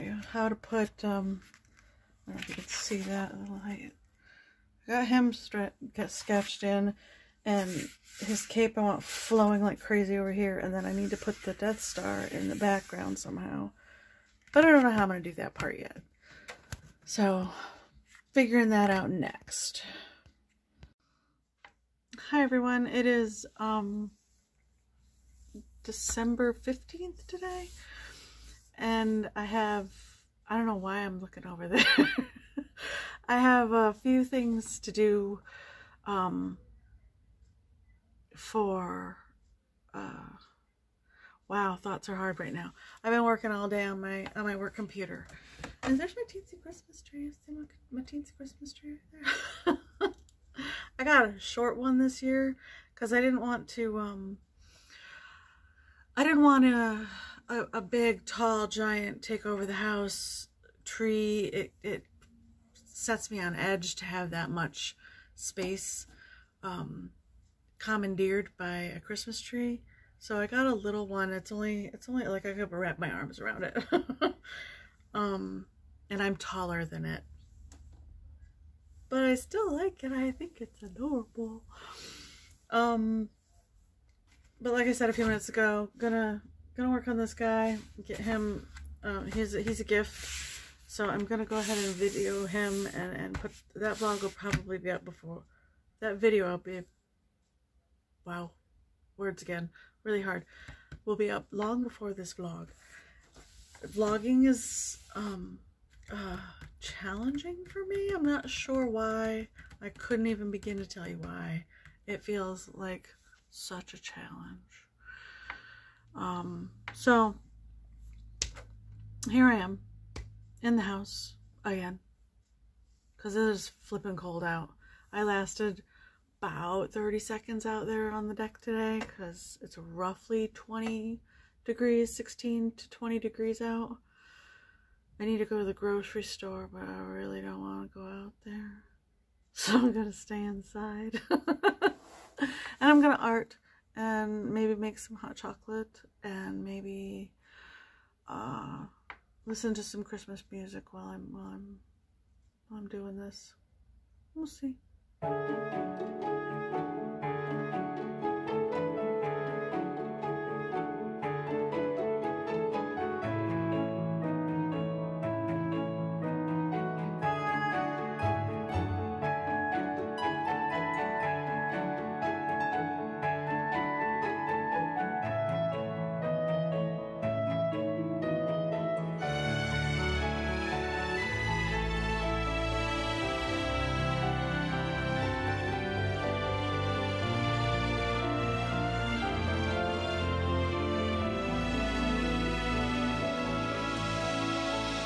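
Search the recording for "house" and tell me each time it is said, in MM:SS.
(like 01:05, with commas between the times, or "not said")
00:59, 02:00.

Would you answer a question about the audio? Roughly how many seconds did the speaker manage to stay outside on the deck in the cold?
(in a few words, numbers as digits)
30.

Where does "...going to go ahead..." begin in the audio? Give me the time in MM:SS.
01:31.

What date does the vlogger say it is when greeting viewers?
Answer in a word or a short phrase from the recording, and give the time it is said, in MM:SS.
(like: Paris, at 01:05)
December 15th, at 00:25.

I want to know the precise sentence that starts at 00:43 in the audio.
I've been working all day on my, on my work computer.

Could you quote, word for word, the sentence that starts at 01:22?
Um, but like I said a few minutes ago, gonna gonna work on this guy, get him.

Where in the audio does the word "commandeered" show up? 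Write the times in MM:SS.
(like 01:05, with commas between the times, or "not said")
01:07.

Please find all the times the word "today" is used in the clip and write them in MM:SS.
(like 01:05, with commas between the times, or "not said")
00:27, 02:08.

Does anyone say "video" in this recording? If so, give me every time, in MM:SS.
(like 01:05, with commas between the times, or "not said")
01:31, 01:36.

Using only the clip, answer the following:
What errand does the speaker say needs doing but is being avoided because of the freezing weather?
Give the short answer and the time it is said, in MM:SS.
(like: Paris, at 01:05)
grocery store, at 02:15.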